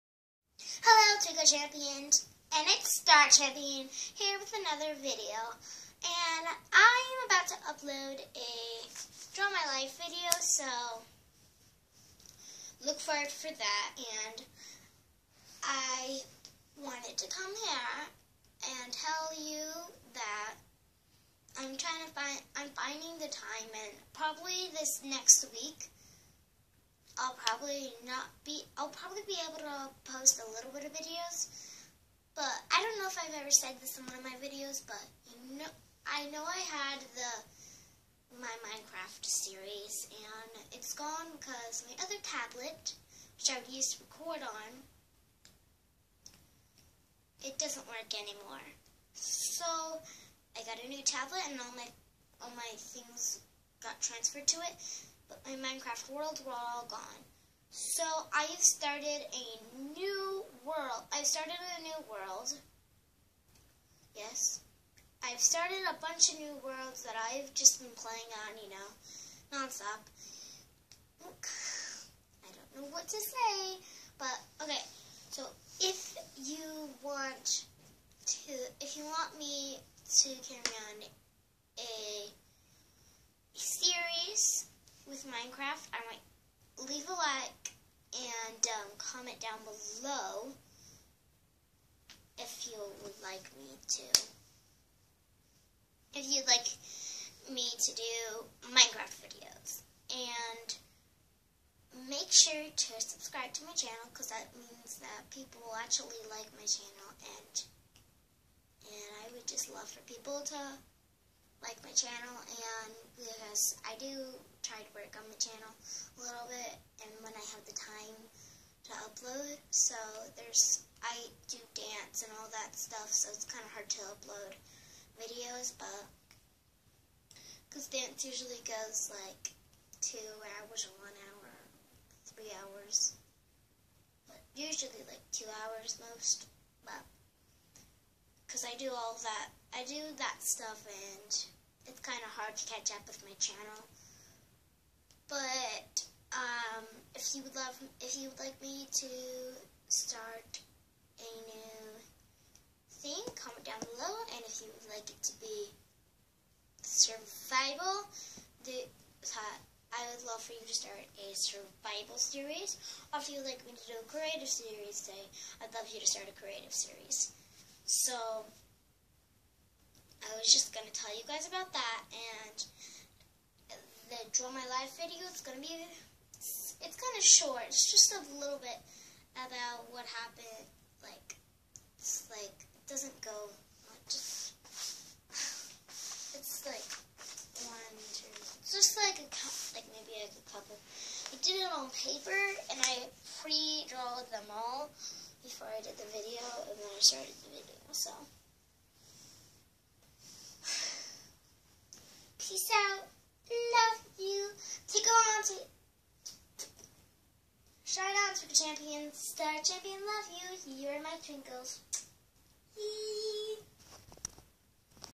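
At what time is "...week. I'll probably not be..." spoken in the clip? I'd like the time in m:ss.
0:25.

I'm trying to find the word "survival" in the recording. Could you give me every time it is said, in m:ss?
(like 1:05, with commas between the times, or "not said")
2:36, 2:41.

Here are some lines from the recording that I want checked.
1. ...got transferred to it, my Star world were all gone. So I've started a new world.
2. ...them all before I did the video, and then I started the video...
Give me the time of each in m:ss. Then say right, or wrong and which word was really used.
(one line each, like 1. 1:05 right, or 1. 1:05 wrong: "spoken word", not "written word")
1. 0:53 wrong: "Minecraft", not "Star"
2. 3:14 right.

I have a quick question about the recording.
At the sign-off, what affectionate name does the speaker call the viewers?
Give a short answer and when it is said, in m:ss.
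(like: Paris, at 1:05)
twinkles, at 3:30.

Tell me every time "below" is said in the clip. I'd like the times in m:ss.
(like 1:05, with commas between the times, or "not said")
1:29, 2:33.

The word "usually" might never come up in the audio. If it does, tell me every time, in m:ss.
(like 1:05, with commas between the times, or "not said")
2:08, 2:14.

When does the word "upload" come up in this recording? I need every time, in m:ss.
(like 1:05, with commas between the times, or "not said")
0:07, 1:59, 2:04.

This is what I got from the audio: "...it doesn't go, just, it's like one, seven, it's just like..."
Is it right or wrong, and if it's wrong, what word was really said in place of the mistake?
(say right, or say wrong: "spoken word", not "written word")
wrong: "two", not "seven".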